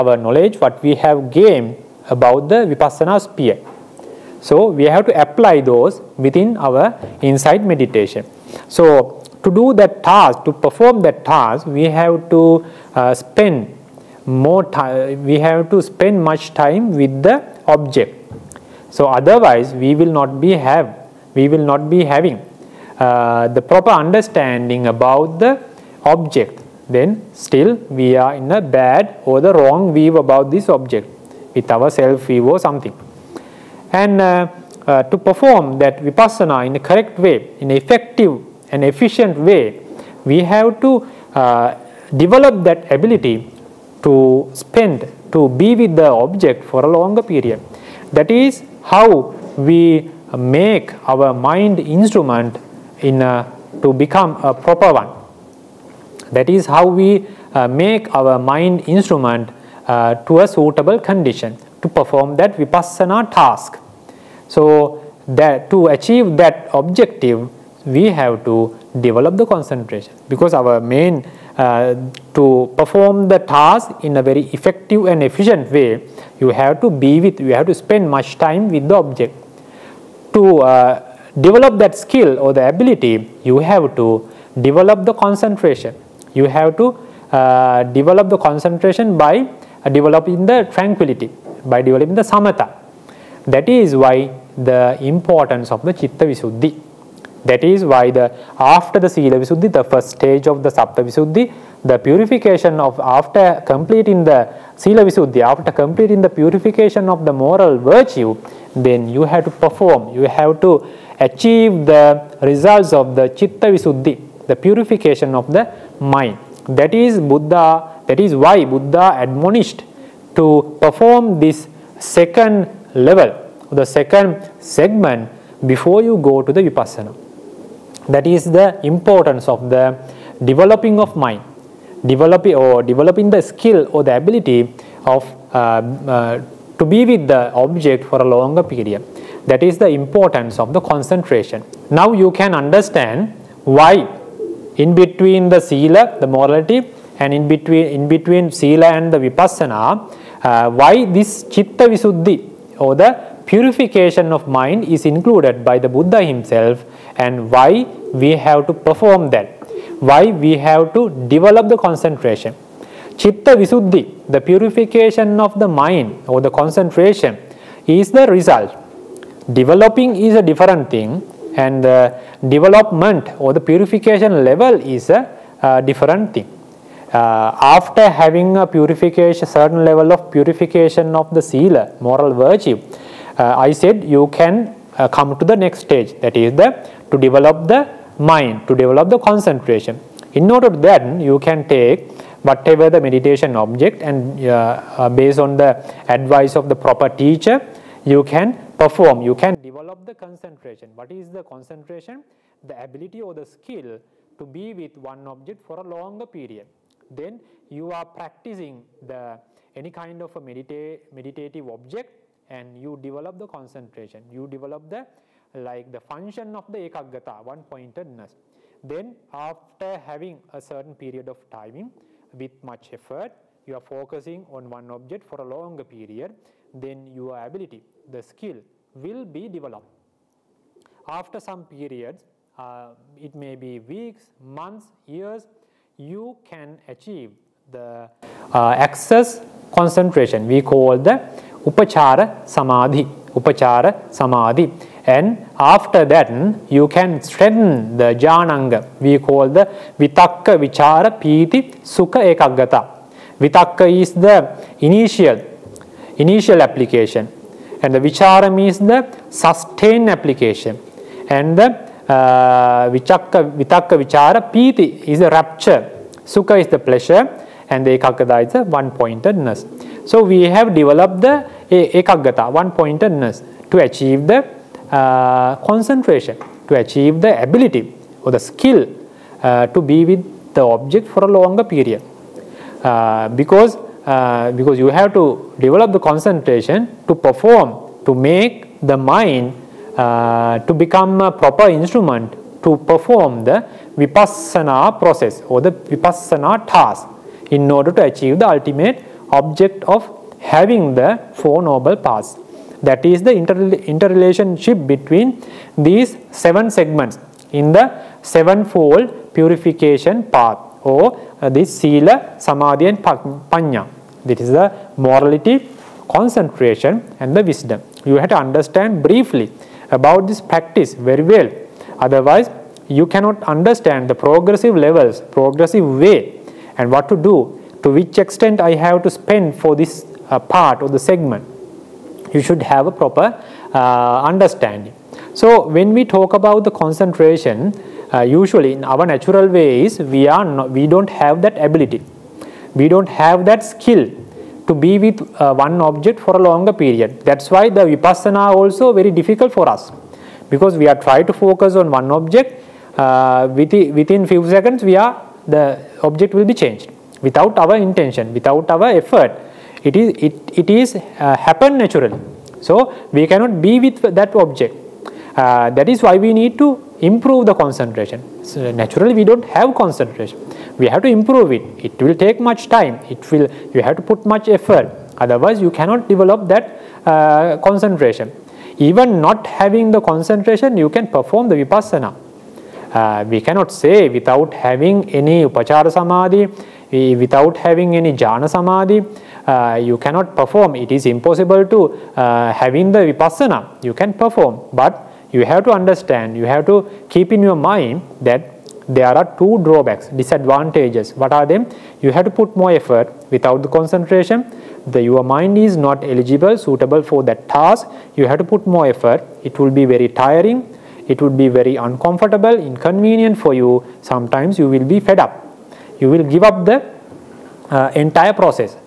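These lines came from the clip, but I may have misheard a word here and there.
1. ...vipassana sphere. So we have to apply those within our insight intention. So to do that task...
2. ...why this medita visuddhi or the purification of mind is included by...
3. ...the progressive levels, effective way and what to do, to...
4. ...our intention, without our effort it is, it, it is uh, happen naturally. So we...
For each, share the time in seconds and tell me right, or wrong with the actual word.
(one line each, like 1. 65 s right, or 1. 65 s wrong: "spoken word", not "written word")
1. 2 s wrong: "meditation", not "intention"
2. 150 s wrong: "chitta", not "medita"
3. 324 s wrong: "progressive", not "effective"
4. 357 s right.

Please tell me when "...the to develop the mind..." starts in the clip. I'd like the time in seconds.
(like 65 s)
186 s.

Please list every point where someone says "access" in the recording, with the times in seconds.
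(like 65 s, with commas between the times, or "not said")
238 s.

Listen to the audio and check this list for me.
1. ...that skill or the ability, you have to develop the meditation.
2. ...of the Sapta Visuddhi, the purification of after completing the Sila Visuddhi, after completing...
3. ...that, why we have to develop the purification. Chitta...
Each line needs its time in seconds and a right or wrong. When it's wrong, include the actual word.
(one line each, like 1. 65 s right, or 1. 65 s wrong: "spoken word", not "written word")
1. 81 s wrong: "concentration", not "meditation"
2. 100 s right
3. 159 s wrong: "concentration", not "purification".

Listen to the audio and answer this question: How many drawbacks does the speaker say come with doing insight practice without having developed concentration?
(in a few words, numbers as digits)
2.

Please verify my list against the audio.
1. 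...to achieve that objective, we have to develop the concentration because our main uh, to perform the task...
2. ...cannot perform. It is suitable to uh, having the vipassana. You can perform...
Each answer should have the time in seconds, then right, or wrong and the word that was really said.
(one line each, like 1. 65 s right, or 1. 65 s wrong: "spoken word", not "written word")
1. 65 s right
2. 389 s wrong: "impossible", not "suitable".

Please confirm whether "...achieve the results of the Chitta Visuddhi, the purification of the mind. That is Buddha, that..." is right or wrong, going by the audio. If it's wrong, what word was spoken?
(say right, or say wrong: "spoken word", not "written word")
right.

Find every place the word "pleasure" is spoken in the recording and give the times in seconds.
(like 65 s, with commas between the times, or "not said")
266 s.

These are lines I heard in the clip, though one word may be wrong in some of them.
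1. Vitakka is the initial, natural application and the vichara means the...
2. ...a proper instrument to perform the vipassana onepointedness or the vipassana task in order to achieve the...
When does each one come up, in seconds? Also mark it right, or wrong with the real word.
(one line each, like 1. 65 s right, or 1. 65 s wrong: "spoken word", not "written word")
1. 253 s wrong: "initial", not "natural"
2. 291 s wrong: "process", not "onepointedness".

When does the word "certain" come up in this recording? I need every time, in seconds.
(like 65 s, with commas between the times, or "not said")
179 s, 220 s.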